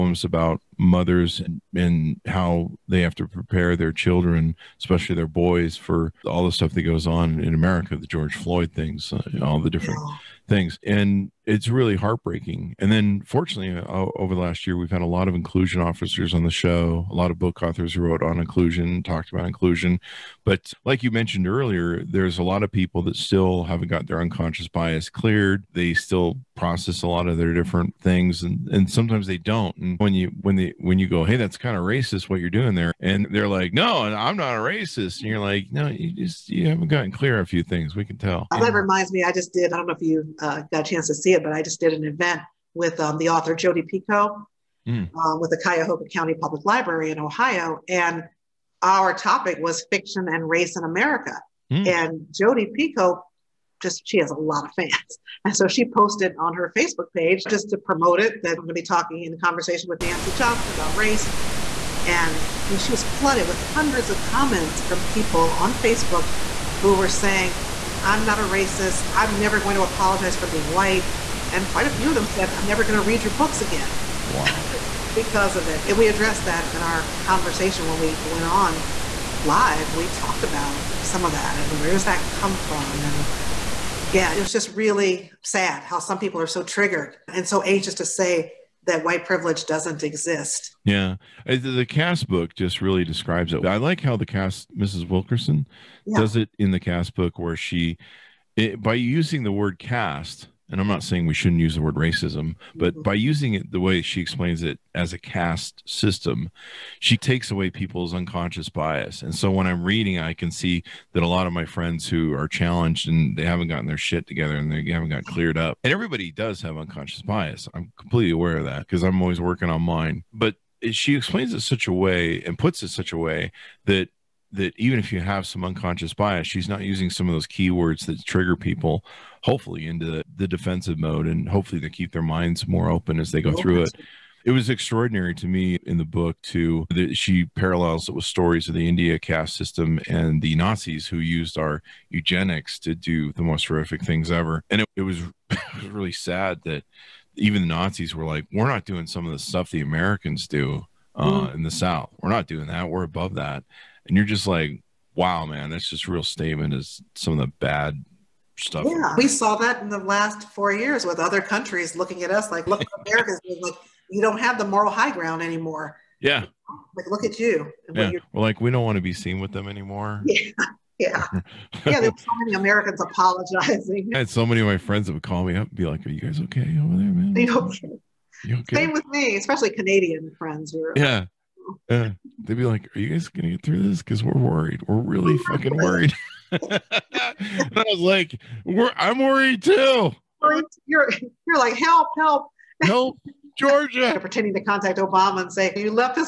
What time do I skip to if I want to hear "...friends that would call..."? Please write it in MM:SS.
02:54.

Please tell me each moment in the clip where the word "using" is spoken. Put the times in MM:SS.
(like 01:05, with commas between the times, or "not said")
01:38, 01:43, 02:06.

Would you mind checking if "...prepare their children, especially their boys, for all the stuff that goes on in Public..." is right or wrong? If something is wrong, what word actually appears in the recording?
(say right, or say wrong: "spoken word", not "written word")
wrong: "America", not "Public".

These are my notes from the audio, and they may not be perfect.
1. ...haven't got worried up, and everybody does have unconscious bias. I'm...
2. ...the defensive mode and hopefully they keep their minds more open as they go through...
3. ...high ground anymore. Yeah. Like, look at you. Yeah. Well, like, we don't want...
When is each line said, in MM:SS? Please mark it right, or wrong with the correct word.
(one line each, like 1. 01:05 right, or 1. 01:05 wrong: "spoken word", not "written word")
1. 01:54 wrong: "cleared", not "worried"
2. 02:10 right
3. 02:44 right.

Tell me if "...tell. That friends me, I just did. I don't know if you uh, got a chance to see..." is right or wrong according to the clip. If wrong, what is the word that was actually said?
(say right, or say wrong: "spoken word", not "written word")
wrong: "reminds", not "friends".